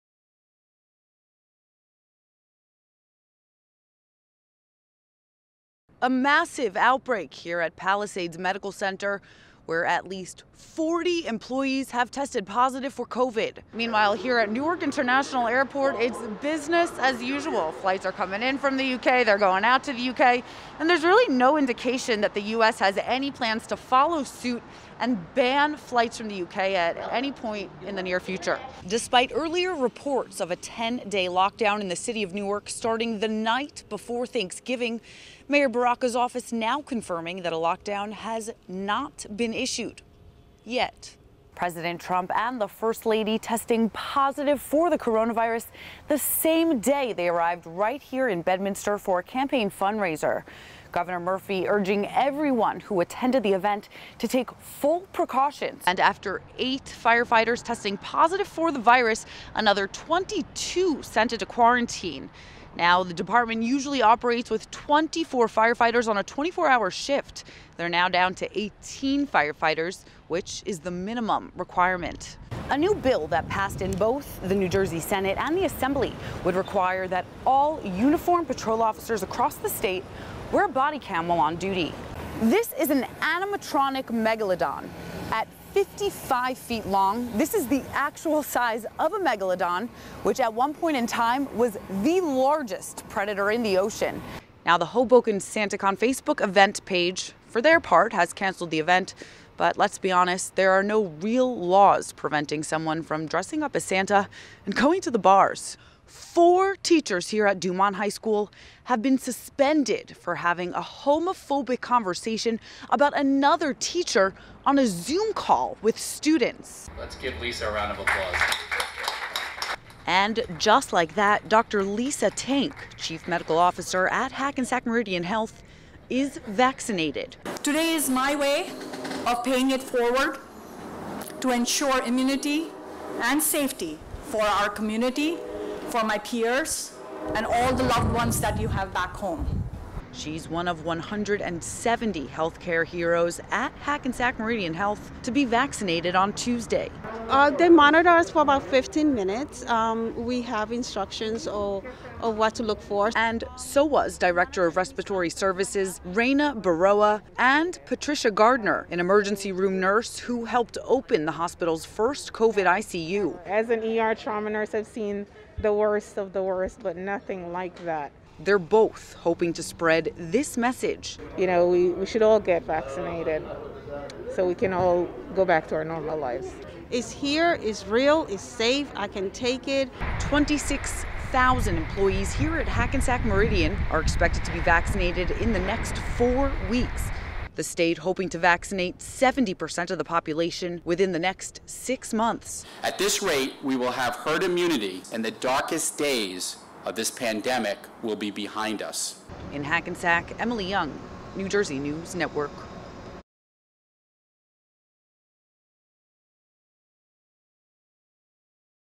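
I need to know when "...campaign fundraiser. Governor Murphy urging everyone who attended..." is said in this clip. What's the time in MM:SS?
00:49.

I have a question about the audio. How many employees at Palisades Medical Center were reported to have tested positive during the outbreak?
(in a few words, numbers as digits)
40.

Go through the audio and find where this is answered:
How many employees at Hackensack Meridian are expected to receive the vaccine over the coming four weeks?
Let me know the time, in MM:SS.
03:00.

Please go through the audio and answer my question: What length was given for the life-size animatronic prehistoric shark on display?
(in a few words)
55 feet.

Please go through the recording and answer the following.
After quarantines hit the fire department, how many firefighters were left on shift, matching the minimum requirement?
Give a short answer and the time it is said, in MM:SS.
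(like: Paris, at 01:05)
18, at 01:08.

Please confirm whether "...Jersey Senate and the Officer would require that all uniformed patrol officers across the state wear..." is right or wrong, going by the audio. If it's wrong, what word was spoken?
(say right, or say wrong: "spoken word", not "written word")
wrong: "Assembly", not "Officer".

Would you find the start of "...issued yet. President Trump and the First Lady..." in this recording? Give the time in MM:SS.
00:39.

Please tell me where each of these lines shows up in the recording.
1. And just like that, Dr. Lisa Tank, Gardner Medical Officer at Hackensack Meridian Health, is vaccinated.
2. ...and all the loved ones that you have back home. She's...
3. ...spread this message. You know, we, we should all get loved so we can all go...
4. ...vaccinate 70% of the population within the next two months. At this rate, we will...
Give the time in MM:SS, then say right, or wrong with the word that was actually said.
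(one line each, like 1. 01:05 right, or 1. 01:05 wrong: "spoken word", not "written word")
1. 02:00 wrong: "Chief", not "Gardner"
2. 02:17 right
3. 02:49 wrong: "vaccinated", not "loved"
4. 03:08 wrong: "six", not "two".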